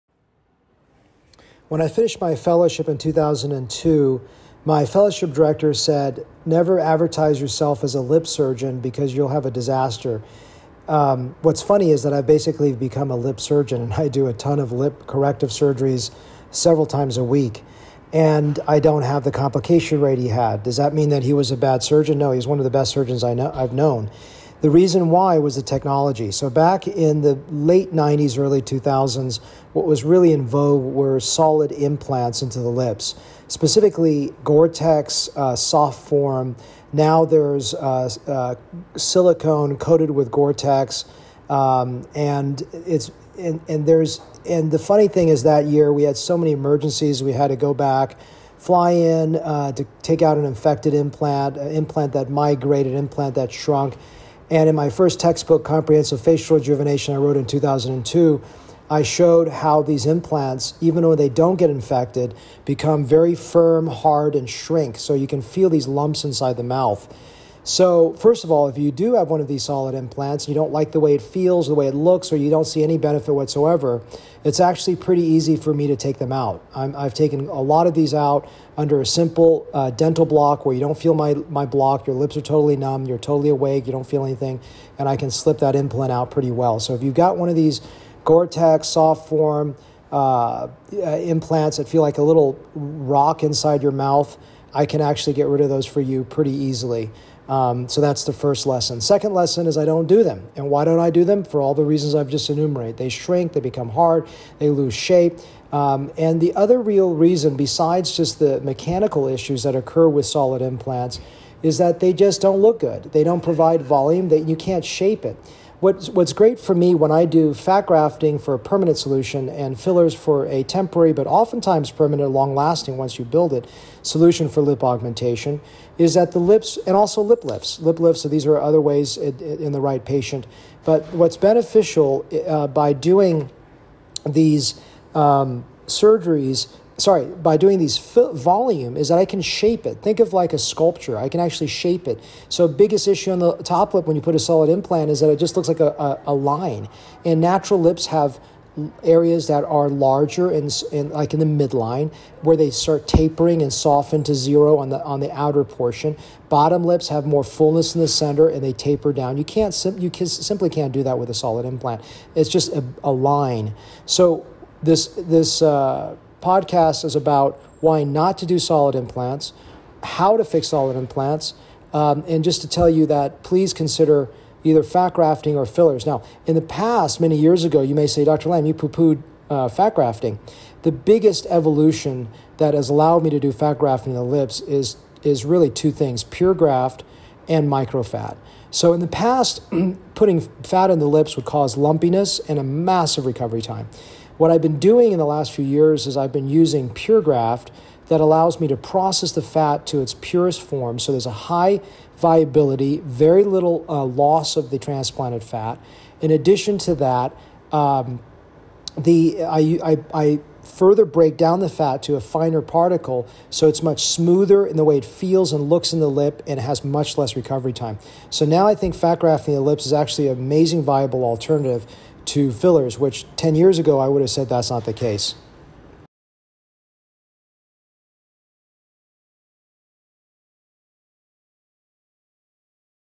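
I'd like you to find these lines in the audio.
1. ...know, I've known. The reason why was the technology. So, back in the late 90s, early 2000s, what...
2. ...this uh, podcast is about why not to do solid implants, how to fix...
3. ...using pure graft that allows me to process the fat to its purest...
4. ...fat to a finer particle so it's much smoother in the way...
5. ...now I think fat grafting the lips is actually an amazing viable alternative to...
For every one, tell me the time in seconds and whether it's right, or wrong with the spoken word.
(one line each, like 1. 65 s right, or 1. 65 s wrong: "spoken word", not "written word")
1. 23 s right
2. 165 s right
3. 196 s right
4. 211 s right
5. 218 s right.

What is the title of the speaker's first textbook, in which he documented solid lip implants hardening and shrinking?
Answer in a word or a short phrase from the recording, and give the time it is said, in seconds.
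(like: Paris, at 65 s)
Comprehensive Facial Rejuvenation, at 55 s.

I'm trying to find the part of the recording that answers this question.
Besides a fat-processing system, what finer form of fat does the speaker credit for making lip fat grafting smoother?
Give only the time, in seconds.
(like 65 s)
187 s.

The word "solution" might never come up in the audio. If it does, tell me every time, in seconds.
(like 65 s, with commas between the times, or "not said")
118 s, 124 s.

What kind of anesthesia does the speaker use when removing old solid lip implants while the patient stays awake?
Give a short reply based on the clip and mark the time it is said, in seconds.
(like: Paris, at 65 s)
dental block, at 79 s.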